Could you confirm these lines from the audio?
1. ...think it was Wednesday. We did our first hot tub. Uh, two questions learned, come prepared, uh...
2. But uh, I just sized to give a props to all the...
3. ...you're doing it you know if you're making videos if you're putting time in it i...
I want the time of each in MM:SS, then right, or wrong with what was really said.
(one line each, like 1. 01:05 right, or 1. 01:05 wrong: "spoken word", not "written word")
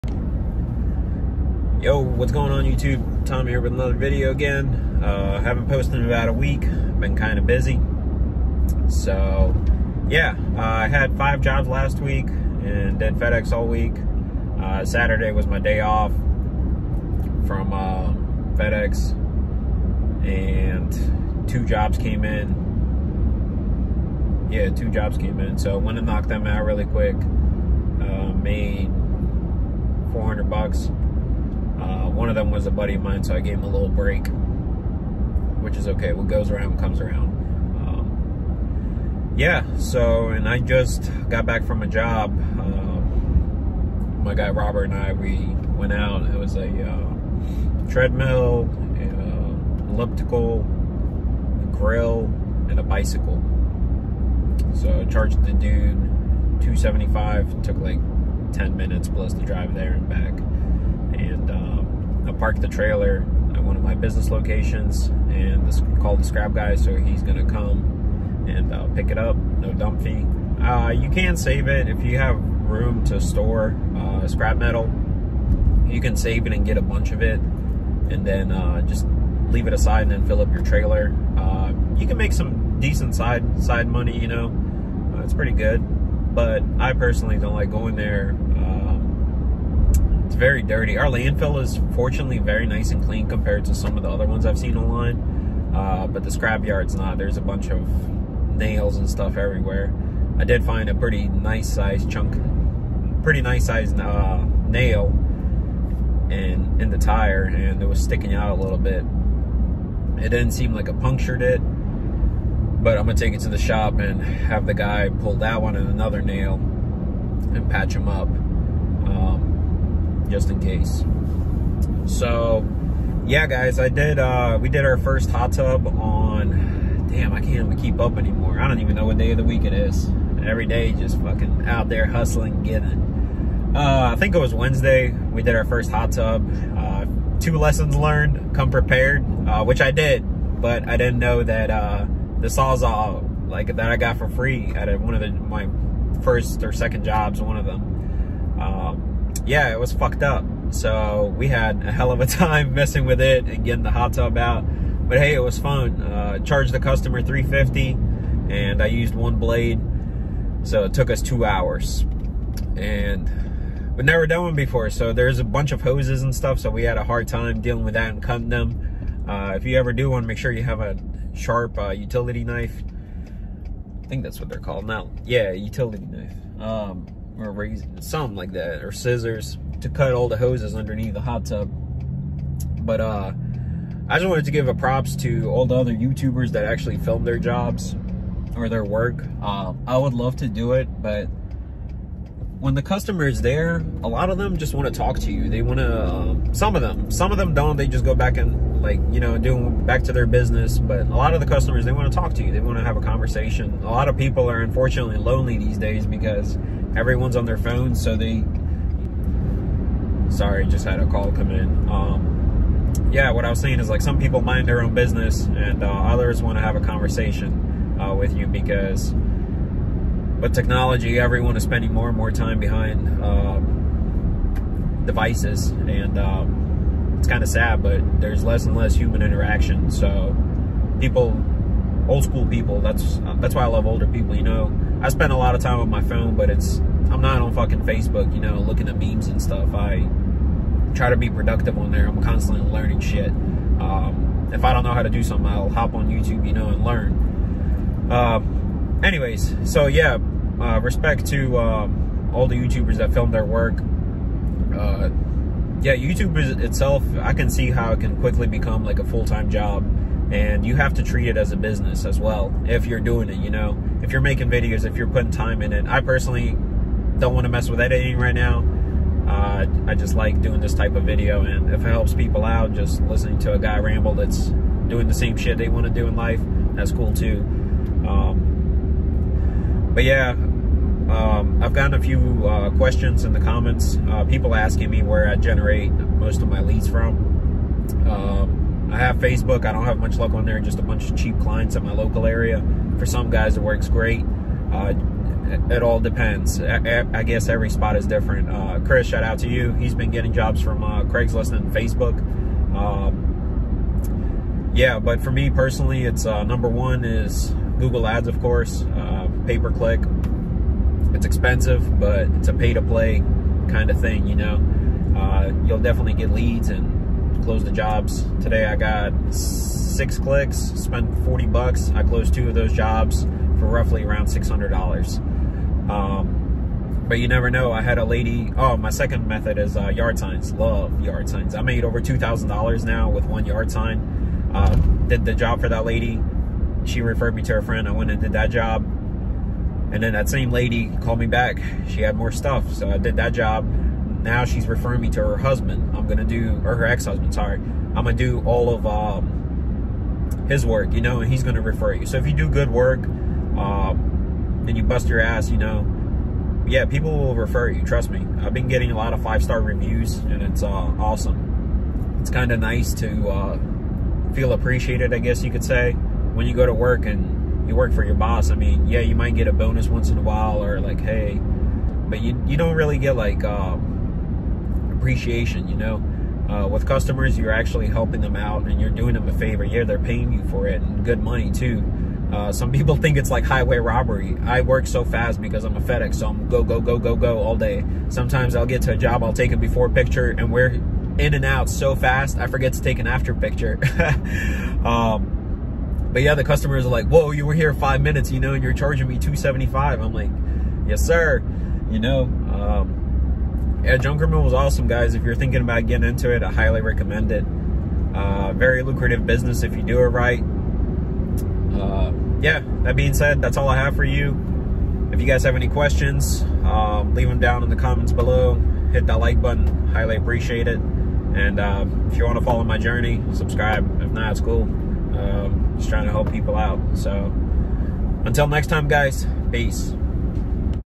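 1. 02:14 wrong: "lessons", not "questions"
2. 03:02 wrong: "wanted", not "sized"
3. 04:22 right.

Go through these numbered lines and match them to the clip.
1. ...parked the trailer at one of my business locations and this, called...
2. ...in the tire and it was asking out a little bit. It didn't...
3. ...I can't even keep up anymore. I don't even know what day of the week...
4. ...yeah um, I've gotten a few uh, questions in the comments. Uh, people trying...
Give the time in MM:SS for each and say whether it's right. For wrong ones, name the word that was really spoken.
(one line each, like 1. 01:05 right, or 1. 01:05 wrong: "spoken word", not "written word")
1. 01:02 right
2. 01:46 wrong: "sticking", not "asking"
3. 02:07 right
4. 04:40 wrong: "asking", not "trying".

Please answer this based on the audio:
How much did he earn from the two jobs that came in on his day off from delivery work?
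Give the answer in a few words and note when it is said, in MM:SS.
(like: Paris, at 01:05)
$400, at 00:30.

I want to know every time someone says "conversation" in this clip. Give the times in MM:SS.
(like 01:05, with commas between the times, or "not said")
03:23, 03:36.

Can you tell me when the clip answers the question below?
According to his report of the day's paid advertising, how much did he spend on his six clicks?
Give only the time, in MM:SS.
05:21.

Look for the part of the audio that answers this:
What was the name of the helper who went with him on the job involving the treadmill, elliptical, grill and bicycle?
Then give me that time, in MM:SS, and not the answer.
00:44.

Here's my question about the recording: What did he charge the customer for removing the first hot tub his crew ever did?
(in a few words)
$350.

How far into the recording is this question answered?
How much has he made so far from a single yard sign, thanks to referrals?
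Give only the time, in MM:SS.
05:31.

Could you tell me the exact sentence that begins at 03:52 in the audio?
That's that's why I love older people.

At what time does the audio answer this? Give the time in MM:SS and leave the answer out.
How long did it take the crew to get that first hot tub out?
02:41.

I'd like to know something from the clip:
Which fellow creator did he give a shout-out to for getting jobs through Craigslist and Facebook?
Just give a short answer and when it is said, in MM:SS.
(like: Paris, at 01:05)
Chris, at 04:58.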